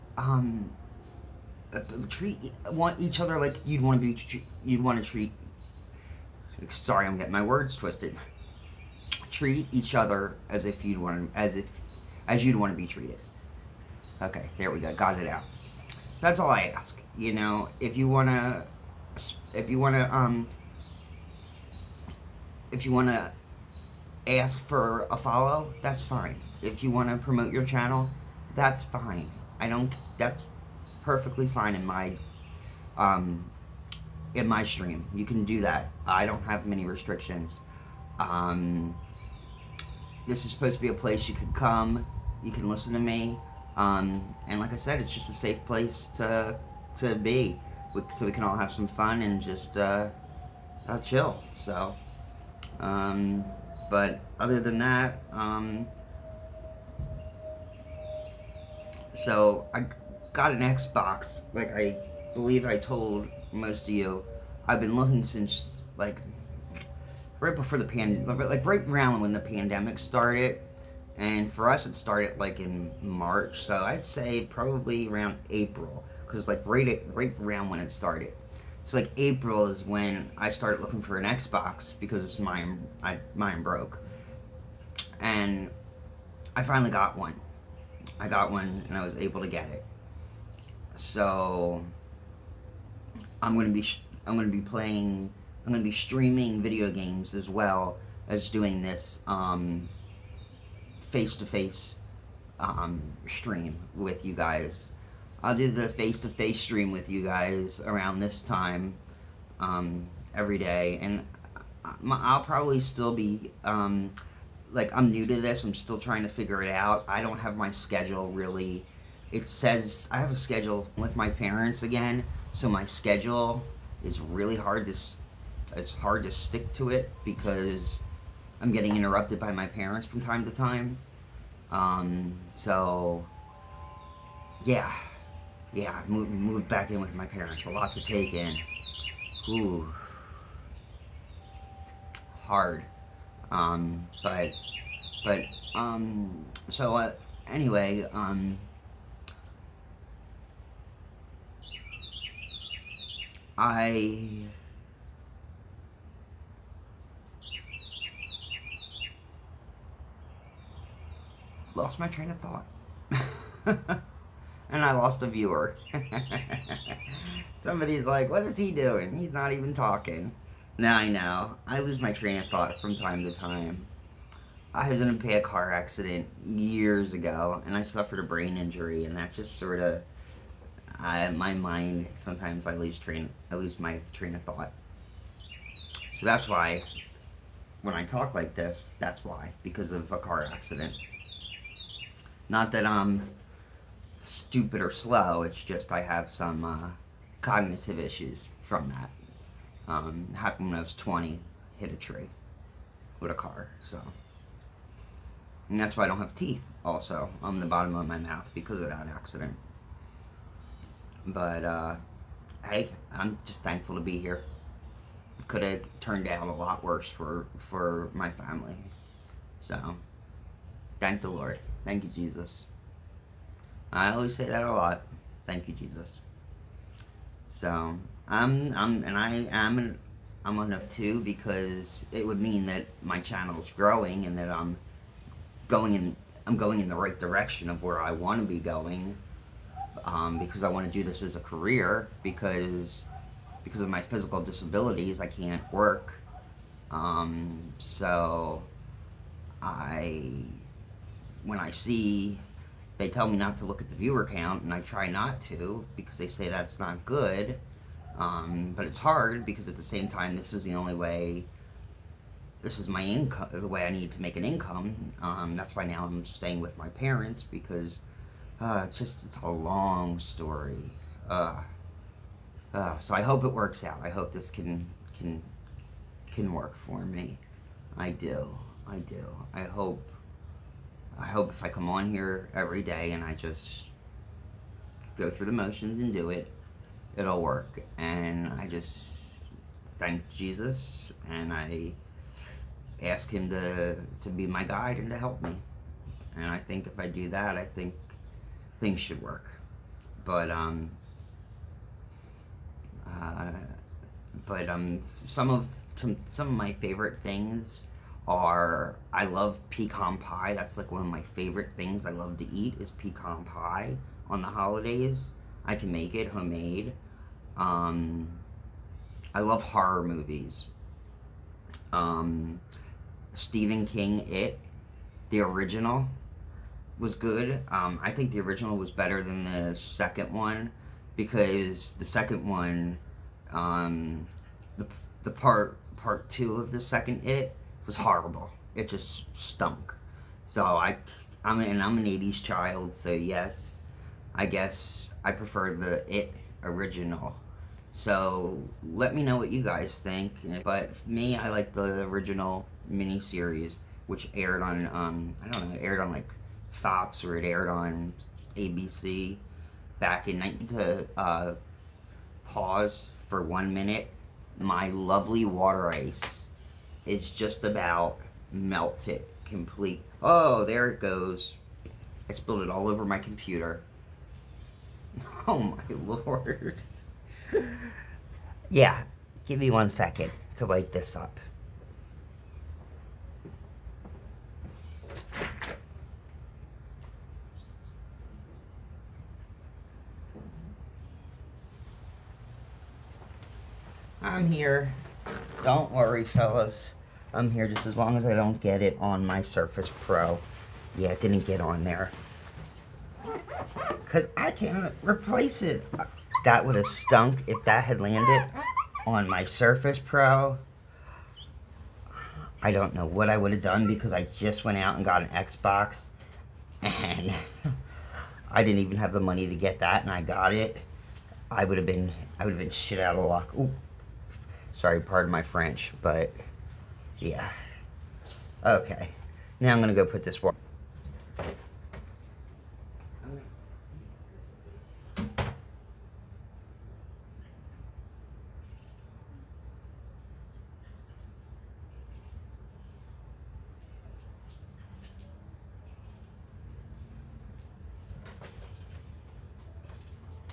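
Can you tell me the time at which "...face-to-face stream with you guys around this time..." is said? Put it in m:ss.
1:45.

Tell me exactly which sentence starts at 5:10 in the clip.
That's like one of my favorite things I love to eat is pecan pie on the holidays.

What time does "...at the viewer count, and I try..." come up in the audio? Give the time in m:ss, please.
4:13.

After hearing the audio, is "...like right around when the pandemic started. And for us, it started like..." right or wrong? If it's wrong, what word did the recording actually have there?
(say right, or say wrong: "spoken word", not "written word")
right.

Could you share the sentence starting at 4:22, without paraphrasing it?
This is my income, the way I need to make an income.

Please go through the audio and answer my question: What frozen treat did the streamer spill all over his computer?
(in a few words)
Water ice.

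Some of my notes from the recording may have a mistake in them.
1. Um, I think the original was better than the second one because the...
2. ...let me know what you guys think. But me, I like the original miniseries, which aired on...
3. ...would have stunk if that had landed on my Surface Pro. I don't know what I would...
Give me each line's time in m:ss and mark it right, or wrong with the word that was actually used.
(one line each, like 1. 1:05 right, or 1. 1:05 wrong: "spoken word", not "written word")
1. 5:27 right
2. 5:48 right
3. 6:46 right.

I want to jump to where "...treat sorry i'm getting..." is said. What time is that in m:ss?
0:05.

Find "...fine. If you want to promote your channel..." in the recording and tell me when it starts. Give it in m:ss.
0:26.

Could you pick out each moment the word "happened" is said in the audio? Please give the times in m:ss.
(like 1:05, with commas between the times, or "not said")
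3:20.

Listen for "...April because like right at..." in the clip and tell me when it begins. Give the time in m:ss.
1:15.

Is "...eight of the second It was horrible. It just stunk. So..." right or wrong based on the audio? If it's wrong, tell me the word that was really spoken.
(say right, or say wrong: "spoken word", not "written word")
wrong: "two", not "eight".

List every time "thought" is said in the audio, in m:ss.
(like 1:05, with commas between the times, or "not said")
2:42, 2:52, 3:04.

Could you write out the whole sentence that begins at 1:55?
I'm still trying to figure it out.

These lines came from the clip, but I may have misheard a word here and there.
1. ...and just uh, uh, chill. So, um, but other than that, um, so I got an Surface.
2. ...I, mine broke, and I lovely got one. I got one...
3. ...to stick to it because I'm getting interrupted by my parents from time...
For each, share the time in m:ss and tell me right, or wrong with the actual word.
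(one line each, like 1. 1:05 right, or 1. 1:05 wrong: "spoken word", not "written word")
1. 0:49 wrong: "Xbox", not "Surface"
2. 1:23 wrong: "finally", not "lovely"
3. 2:06 right.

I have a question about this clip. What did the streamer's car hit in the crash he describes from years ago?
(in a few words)
A tree.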